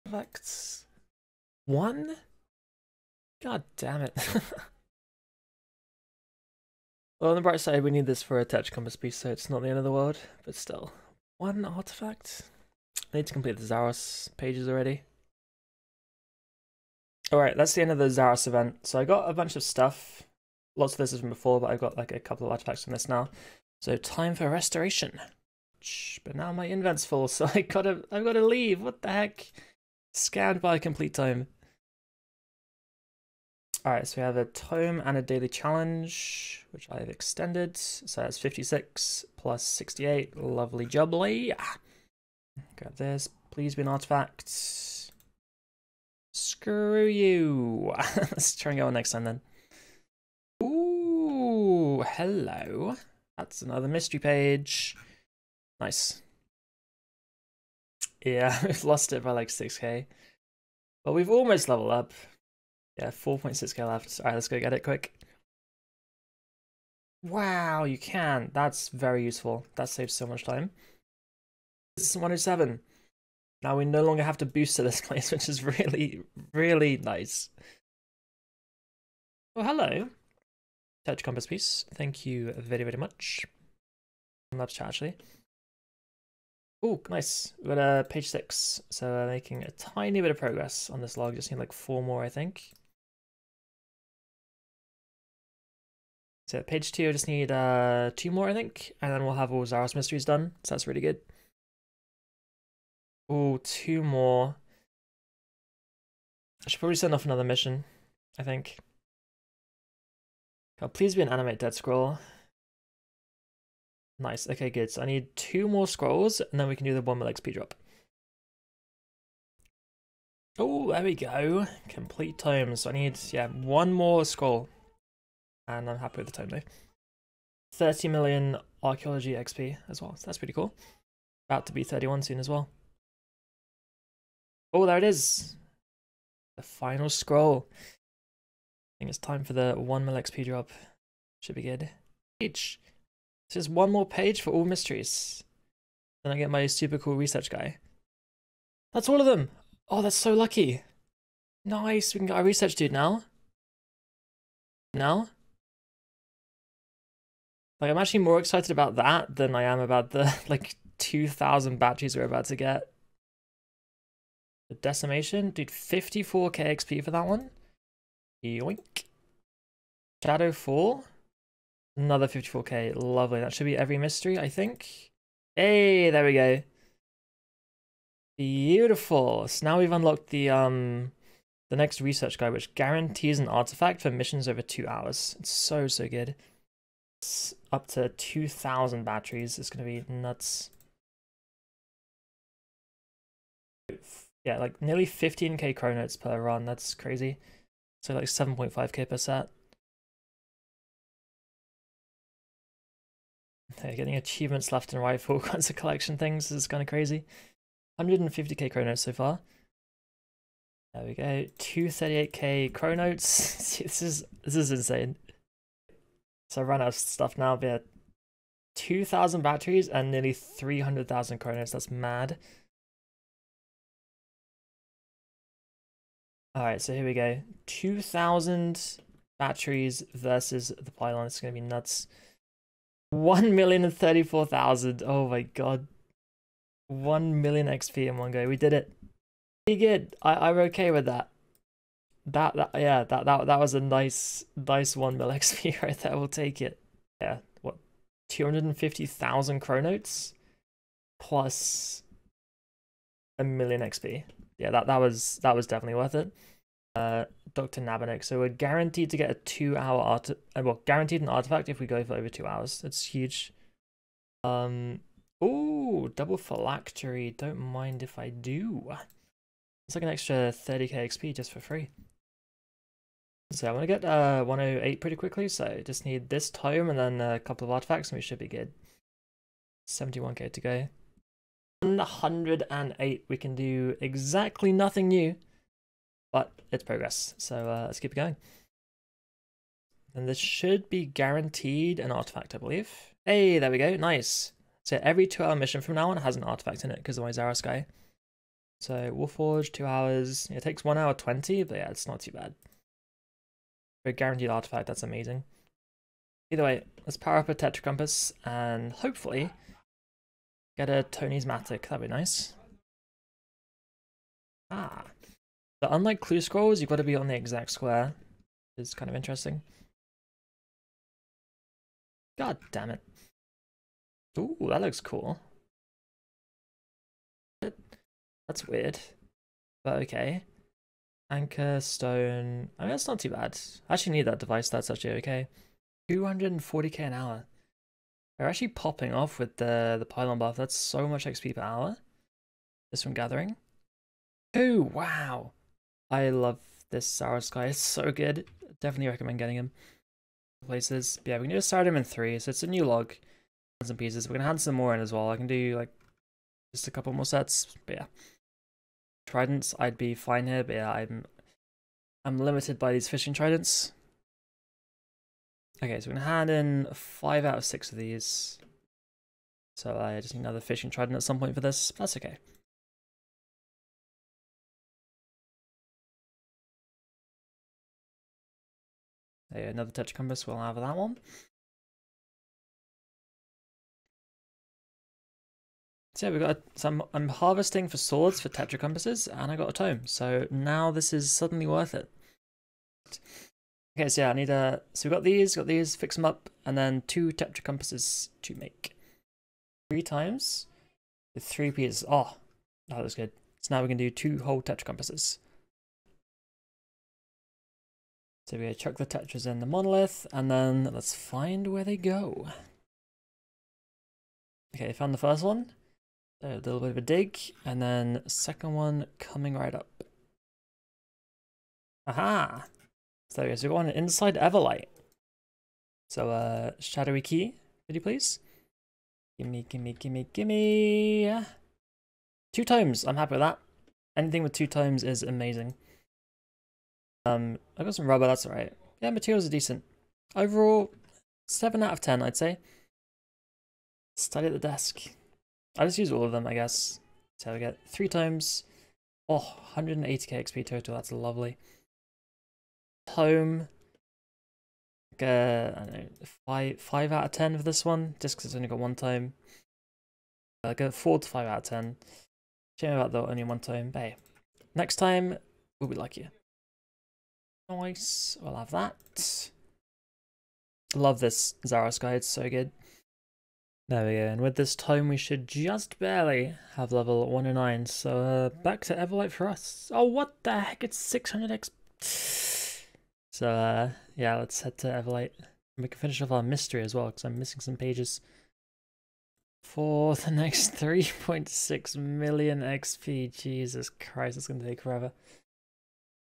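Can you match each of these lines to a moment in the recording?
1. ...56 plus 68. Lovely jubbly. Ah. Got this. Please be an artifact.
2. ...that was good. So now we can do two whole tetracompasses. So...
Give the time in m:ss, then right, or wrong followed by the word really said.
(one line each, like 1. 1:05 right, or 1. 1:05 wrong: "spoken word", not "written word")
1. 0:38 right
2. 6:42 right.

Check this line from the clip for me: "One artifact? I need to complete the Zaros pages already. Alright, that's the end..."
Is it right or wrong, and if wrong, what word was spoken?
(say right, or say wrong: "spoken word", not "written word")
right.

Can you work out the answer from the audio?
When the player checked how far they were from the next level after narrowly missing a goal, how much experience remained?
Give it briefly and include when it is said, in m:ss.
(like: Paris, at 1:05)
4.6k, at 1:03.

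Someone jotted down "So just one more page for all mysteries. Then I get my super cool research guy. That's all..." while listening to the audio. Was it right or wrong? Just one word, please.
right.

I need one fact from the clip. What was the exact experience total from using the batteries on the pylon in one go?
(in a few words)
1,034,000.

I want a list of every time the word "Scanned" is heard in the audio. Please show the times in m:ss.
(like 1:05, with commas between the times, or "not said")
0:30.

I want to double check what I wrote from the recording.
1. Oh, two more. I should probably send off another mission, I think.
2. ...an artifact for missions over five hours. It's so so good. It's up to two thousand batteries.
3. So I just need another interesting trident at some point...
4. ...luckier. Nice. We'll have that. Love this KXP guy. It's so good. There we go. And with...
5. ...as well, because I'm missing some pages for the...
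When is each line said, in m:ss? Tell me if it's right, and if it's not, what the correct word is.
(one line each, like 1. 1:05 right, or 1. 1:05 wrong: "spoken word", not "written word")
1. 1:43 right
2. 3:03 wrong: "two", not "five"
3. 6:09 wrong: "fishing", not "interesting"
4. 7:45 wrong: "Zara", not "KXP"
5. 8:06 right.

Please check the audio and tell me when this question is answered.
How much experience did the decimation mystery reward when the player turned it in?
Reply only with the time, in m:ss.
2:45.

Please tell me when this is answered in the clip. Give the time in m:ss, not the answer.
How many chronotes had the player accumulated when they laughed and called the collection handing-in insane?
3:31.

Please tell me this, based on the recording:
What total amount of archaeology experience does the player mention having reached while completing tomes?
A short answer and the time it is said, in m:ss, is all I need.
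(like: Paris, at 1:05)
30 million, at 2:07.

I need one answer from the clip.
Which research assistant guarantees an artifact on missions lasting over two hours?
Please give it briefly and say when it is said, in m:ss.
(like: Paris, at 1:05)
Dr. Nabanik, at 4:17.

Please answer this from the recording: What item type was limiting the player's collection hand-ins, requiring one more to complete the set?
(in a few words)
fishing trident.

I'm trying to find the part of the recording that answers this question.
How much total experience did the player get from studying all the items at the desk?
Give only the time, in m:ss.
7:29.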